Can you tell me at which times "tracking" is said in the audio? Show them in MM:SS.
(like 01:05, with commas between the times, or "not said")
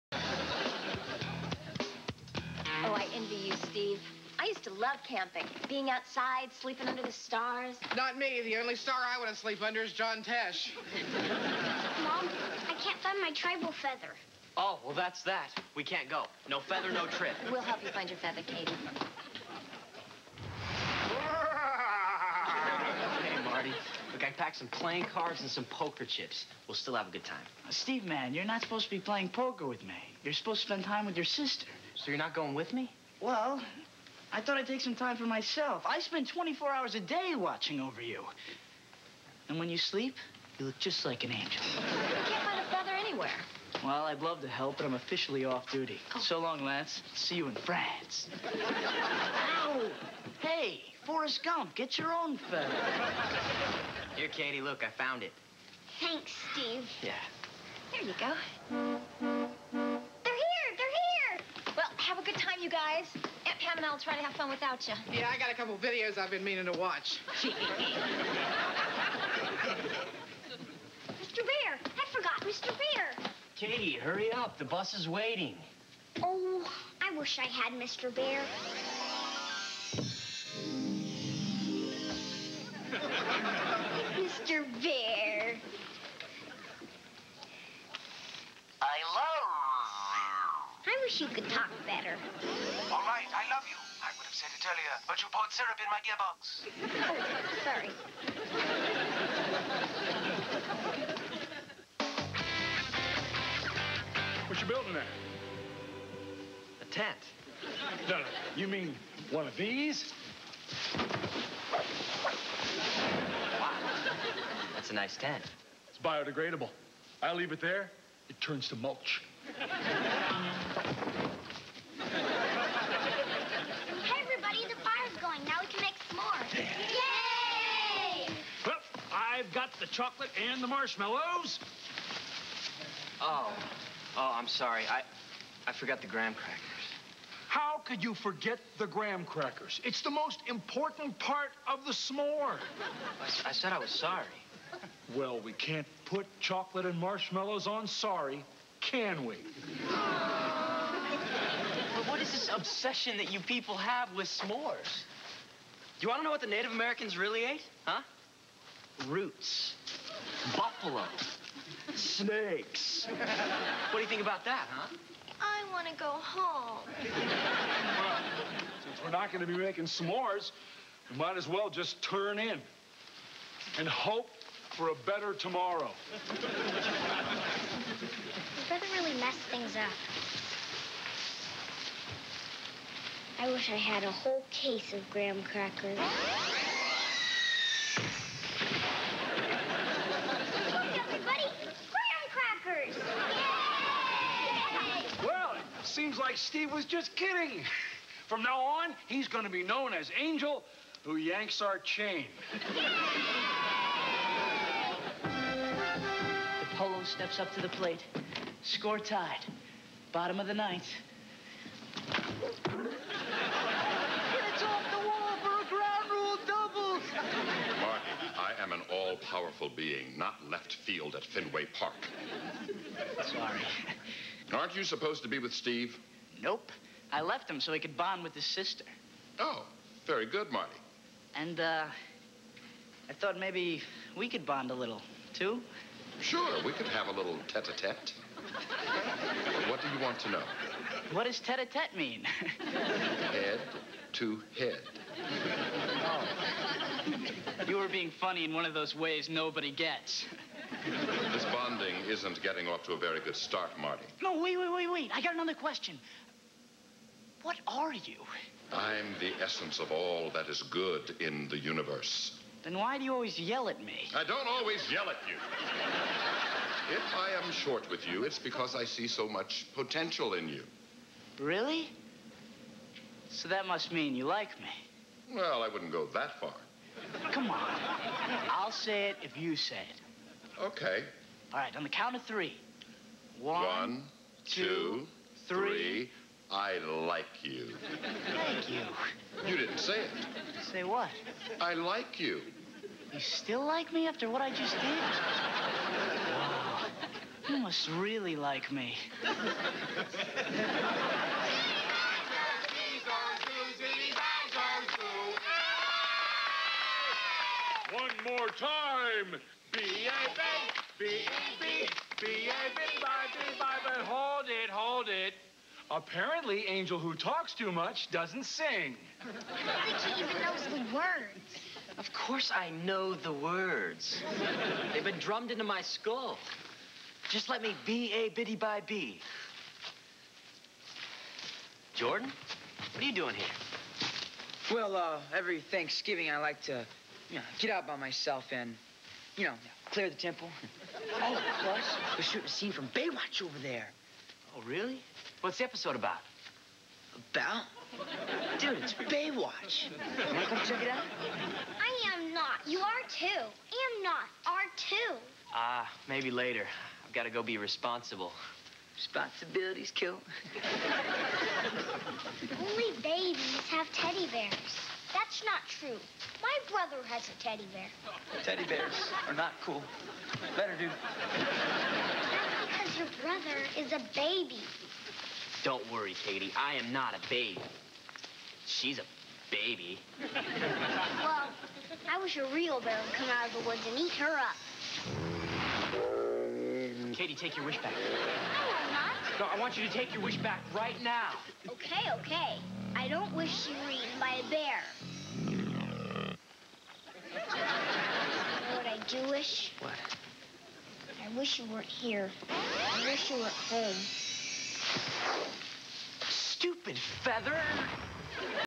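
not said.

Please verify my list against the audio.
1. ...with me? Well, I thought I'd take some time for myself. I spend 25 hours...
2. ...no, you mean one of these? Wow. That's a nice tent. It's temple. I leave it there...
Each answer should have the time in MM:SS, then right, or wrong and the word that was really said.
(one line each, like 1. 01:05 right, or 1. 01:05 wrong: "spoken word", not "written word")
1. 00:32 wrong: "24", not "25"
2. 01:48 wrong: "biodegradable", not "temple".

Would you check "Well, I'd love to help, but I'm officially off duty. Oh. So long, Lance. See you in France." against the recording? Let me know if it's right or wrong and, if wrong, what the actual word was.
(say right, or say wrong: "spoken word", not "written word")
right.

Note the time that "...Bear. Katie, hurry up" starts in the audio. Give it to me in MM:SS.
01:12.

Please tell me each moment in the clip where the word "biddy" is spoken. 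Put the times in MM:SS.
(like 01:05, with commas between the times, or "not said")
05:28.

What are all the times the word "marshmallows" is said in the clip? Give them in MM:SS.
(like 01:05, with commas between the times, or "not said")
02:10, 02:26.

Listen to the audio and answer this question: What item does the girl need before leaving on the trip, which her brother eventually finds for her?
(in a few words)
tribal feather.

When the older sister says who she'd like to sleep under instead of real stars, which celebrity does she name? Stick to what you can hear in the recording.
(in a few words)
John Tesh.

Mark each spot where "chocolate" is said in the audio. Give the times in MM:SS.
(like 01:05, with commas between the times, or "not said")
02:09, 02:26.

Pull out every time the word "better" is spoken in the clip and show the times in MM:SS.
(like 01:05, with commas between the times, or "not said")
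01:31, 02:55, 06:10.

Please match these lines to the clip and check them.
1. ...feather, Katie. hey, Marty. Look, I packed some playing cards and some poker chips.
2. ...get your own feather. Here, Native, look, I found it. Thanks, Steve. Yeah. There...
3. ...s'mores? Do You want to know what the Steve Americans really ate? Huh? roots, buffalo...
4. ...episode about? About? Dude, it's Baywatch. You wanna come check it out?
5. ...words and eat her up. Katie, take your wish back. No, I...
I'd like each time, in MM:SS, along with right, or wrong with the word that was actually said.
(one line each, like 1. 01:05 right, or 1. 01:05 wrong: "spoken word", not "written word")
1. 00:18 right
2. 00:51 wrong: "Katie", not "Native"
3. 02:34 wrong: "Native", not "Steve"
4. 05:45 right
5. 06:23 wrong: "woods", not "words".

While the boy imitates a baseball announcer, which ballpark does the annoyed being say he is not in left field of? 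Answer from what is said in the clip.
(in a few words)
Fenway Park.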